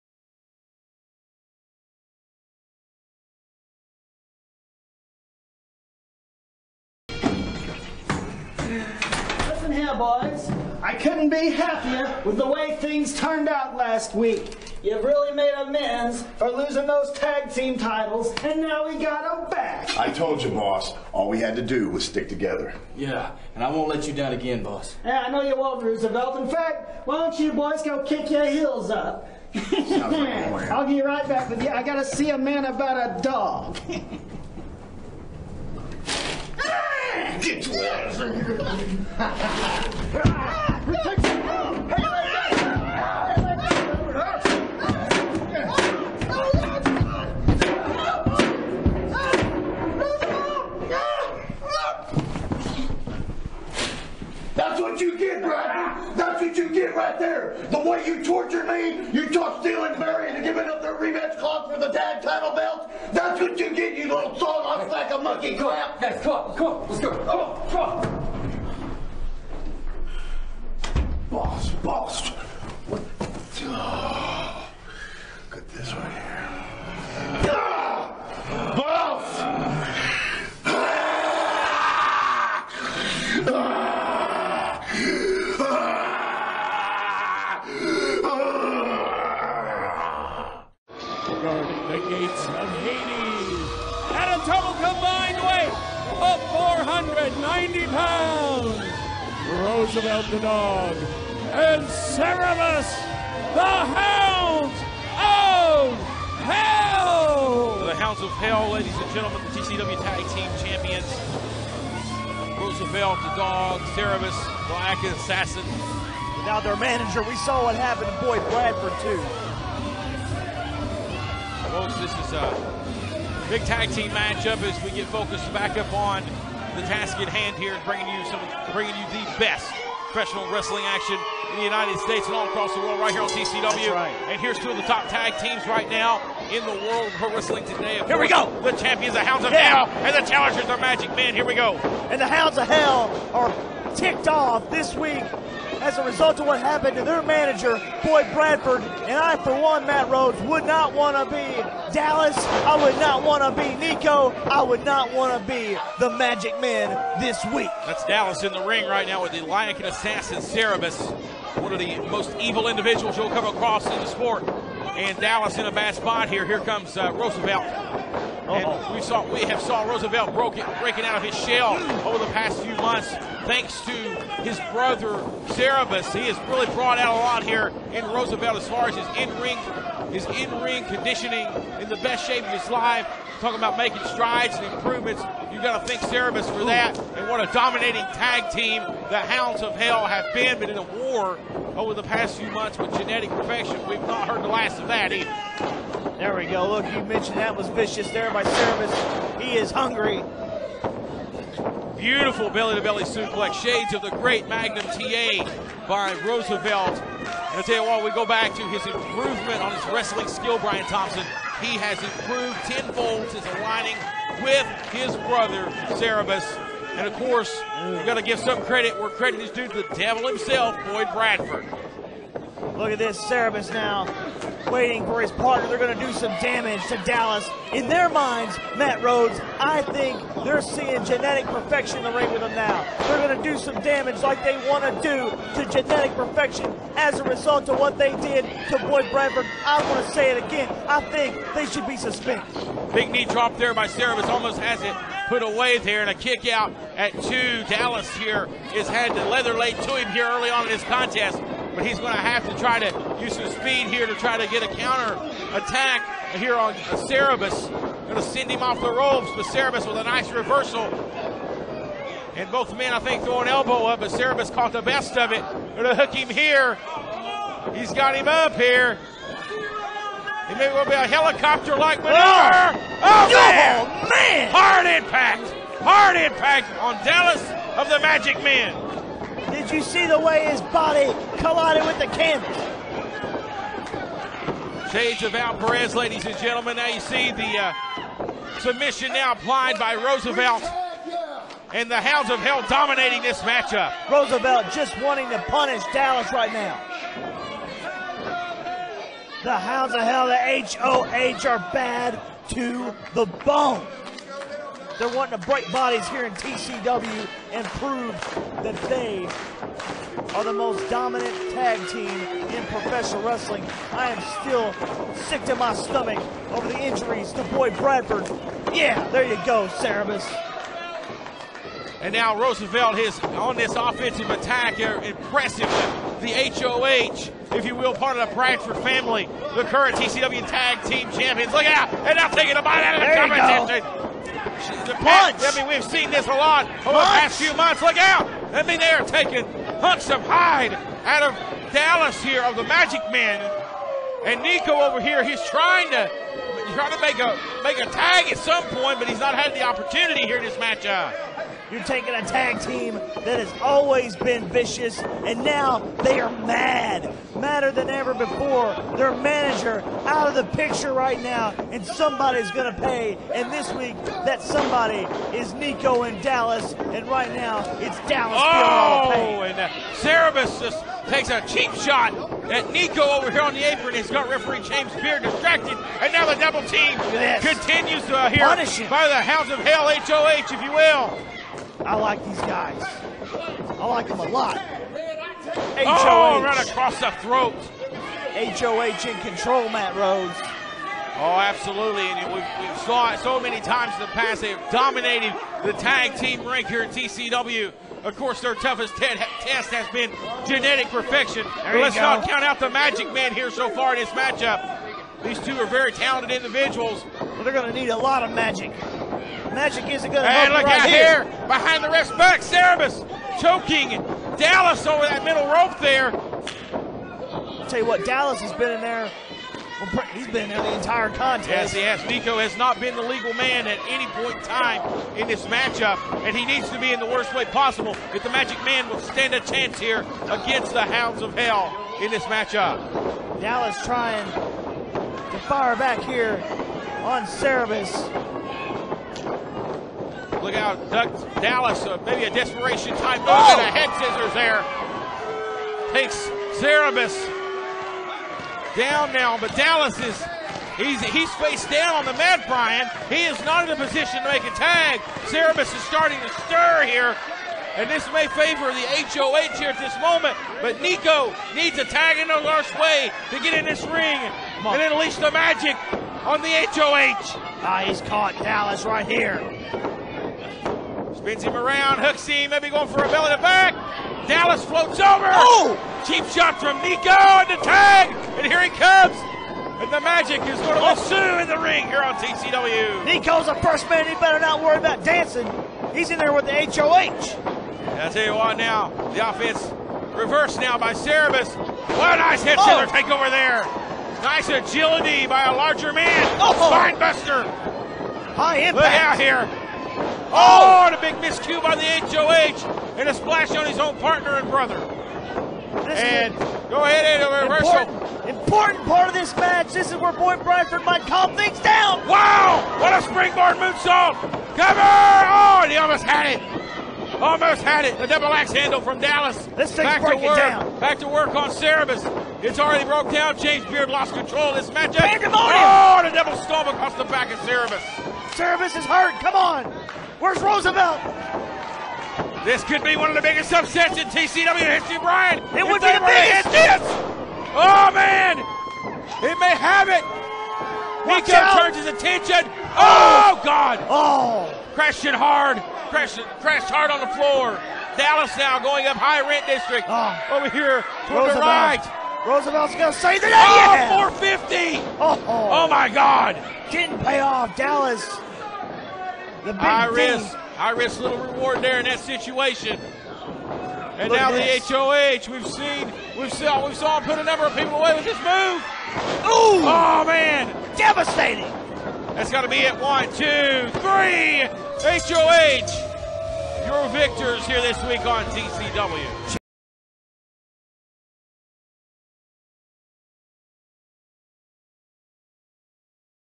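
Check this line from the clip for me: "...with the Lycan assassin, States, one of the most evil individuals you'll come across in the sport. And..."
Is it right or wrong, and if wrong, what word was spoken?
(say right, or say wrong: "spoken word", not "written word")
wrong: "Cerebus", not "States".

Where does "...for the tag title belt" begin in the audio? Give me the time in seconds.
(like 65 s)
61 s.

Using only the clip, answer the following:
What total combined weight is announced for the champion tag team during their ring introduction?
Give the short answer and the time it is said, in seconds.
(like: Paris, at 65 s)
490 pounds, at 96 s.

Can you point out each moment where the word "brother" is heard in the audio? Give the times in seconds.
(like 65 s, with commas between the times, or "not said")
174 s, 215 s, 504 s.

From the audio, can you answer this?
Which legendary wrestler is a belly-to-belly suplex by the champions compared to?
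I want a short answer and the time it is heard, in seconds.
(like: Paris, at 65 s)
Magnum TA, at 204 s.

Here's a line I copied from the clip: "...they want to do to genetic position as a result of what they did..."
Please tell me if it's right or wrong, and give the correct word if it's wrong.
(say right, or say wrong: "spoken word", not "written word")
wrong: "perfection", not "position".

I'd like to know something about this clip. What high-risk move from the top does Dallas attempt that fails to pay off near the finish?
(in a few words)
450.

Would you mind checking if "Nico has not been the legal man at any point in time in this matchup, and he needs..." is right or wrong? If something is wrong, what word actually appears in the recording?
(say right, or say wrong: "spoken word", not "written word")
right.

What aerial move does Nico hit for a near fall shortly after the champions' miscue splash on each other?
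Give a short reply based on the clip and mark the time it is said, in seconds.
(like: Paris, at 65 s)
springboard moonsault, at 513 s.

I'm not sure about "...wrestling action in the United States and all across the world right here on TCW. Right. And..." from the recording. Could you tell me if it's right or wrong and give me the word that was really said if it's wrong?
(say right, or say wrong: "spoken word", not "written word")
right.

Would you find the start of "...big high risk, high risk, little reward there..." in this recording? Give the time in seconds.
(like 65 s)
559 s.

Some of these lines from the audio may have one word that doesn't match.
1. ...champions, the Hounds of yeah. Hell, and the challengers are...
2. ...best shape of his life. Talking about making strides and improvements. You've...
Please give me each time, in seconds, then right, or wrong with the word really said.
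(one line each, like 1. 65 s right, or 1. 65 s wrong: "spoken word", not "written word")
1. 138 s right
2. 182 s right.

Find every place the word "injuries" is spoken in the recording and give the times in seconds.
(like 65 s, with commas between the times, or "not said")
316 s.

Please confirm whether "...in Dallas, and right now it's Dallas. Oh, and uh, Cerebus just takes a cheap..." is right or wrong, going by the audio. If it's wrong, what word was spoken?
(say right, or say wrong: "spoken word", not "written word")
right.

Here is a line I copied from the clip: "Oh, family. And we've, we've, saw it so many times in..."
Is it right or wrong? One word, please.
wrong.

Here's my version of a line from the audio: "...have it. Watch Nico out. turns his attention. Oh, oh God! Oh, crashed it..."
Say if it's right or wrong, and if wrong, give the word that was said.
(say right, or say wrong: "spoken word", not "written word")
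right.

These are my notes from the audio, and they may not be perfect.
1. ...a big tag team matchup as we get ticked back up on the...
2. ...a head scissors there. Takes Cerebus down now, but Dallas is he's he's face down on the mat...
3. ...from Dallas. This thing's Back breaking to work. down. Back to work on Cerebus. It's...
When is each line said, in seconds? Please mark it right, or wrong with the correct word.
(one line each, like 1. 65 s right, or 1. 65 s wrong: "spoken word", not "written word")
1. 122 s wrong: "focused", not "ticked"
2. 443 s right
3. 518 s right.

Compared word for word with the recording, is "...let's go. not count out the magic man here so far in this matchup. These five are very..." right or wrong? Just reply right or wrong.
wrong.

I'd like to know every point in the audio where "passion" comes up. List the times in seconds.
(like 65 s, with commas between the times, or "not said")
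not said.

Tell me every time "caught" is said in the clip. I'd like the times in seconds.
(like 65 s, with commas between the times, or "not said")
264 s, 468 s.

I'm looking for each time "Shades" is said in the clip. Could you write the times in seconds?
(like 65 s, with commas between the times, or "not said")
203 s, 284 s.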